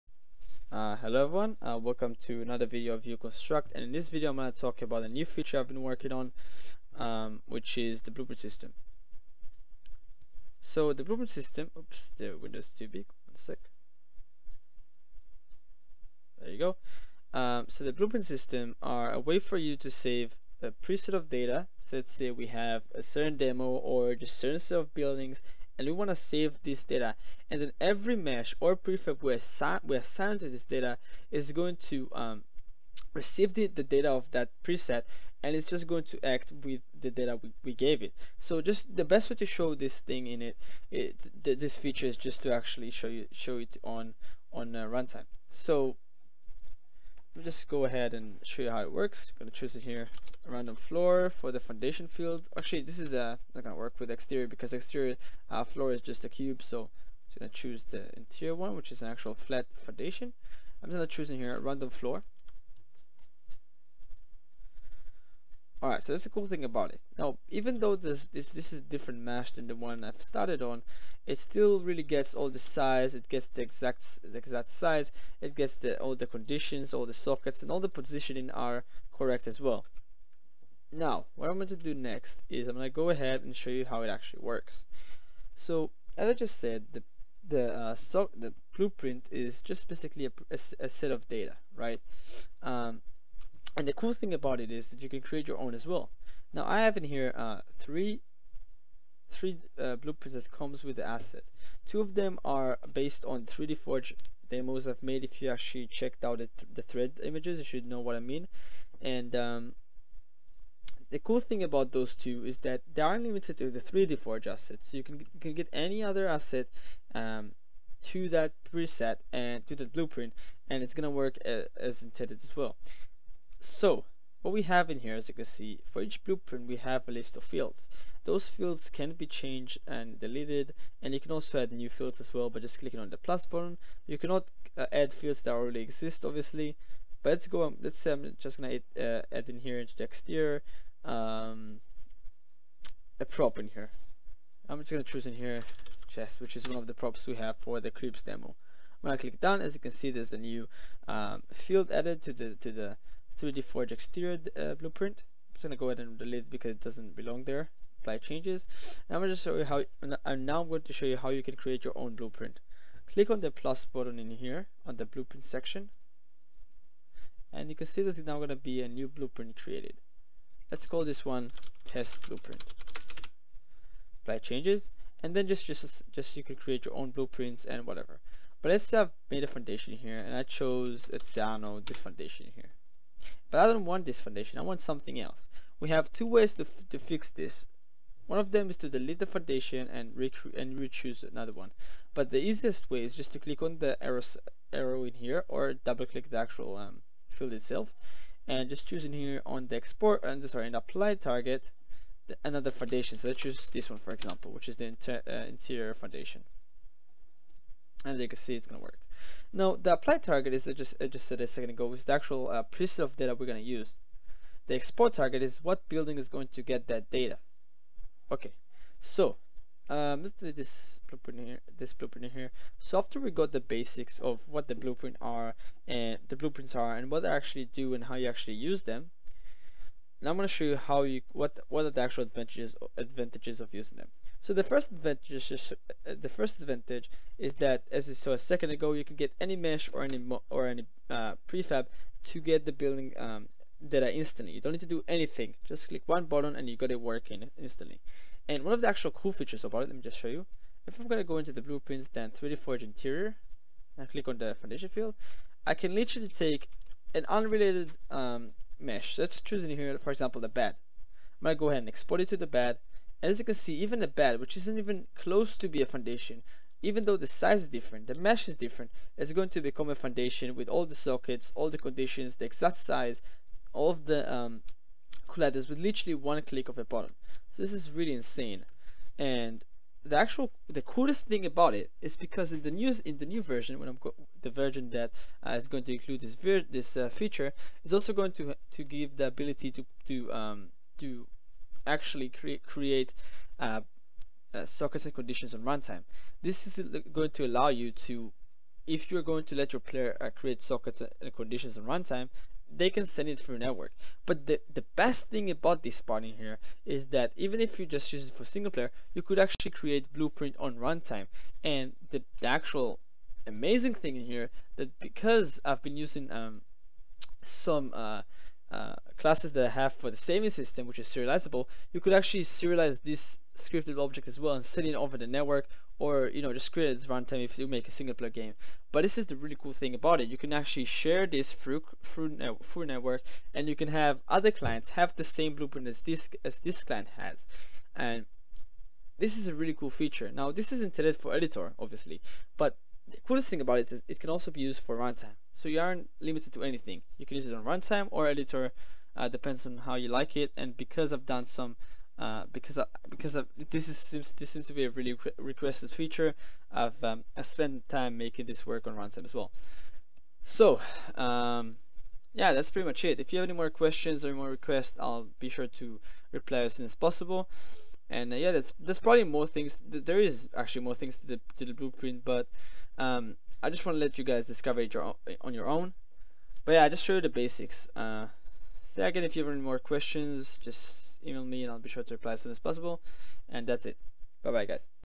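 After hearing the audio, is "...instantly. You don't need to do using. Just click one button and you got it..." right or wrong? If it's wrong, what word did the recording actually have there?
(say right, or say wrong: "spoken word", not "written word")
wrong: "anything", not "using".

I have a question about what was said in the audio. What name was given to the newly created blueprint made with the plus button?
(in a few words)
test blueprint.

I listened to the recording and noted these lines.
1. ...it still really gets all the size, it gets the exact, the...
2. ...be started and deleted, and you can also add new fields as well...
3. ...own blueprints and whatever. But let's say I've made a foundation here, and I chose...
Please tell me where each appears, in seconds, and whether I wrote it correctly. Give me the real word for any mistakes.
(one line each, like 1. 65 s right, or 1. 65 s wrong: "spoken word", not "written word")
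1. 71 s right
2. 129 s wrong: "changed", not "started"
3. 176 s right.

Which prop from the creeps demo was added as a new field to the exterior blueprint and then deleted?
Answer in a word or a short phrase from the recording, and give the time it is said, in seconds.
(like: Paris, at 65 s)
Chest, at 146 s.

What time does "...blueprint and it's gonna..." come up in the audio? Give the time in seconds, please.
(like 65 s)
119 s.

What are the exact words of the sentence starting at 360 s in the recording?
So um, yeah, that's pretty much it.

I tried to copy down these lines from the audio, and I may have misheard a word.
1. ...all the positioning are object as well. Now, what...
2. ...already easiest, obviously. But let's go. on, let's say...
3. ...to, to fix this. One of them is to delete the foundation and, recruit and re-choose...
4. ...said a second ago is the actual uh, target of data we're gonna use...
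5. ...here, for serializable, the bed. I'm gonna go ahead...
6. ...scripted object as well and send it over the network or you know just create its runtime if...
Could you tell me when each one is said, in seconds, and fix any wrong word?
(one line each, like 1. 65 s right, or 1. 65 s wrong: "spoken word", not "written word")
1. 77 s wrong: "correct", not "object"
2. 135 s wrong: "exist", not "easiest"
3. 186 s right
4. 211 s wrong: "preset", not "target"
5. 259 s wrong: "example", not "serializable"
6. 323 s right.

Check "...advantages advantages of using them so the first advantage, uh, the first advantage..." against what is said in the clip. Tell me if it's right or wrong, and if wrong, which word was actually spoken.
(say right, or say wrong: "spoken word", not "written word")
right.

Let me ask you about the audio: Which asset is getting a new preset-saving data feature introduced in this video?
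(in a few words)
uConstruct.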